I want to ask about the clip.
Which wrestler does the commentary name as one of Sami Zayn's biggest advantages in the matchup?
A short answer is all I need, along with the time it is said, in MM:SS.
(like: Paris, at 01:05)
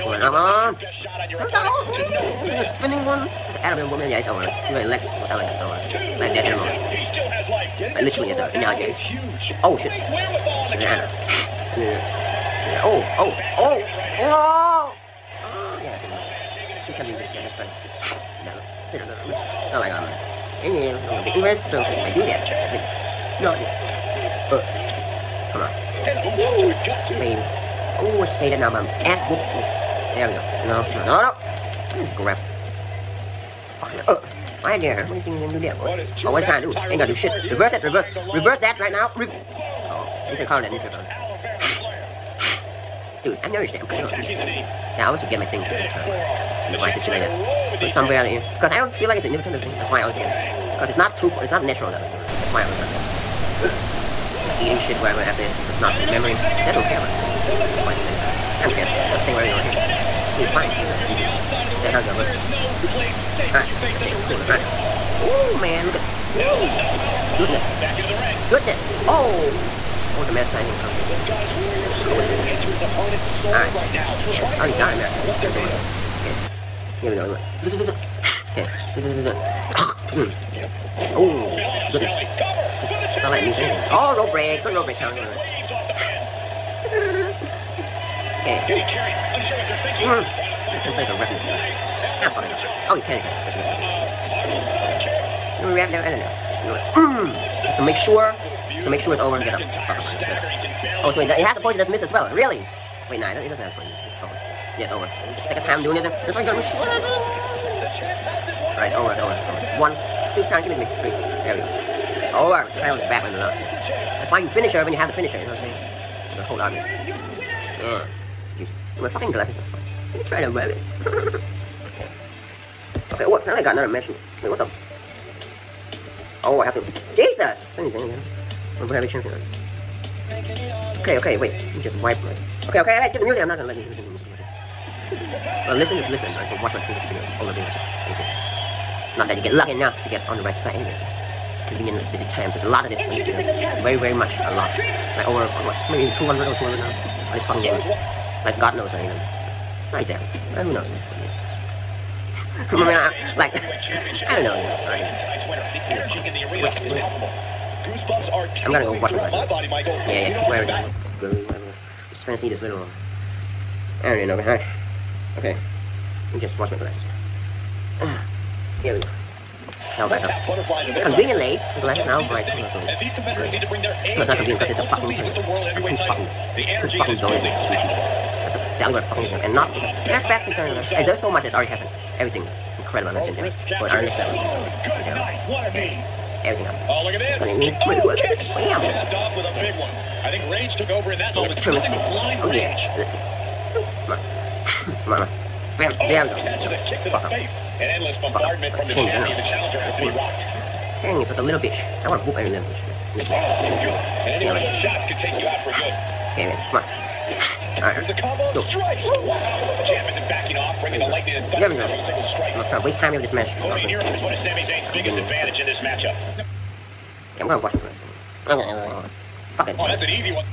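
Cody Nero, at 03:33.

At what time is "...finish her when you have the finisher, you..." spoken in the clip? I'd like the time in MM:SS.
01:54.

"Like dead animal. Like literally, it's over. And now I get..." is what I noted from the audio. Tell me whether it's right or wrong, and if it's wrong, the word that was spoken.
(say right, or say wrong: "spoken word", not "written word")
right.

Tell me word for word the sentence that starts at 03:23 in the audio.
This oh, and any one of those shots could take you out for good.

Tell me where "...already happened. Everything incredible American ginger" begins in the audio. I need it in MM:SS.
03:01.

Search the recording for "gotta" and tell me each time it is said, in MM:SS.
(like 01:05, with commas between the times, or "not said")
01:46.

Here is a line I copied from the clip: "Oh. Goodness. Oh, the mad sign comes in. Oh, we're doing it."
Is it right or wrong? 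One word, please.
right.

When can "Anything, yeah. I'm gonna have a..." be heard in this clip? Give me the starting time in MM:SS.
02:07.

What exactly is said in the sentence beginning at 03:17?
An endless bombardment from the champion.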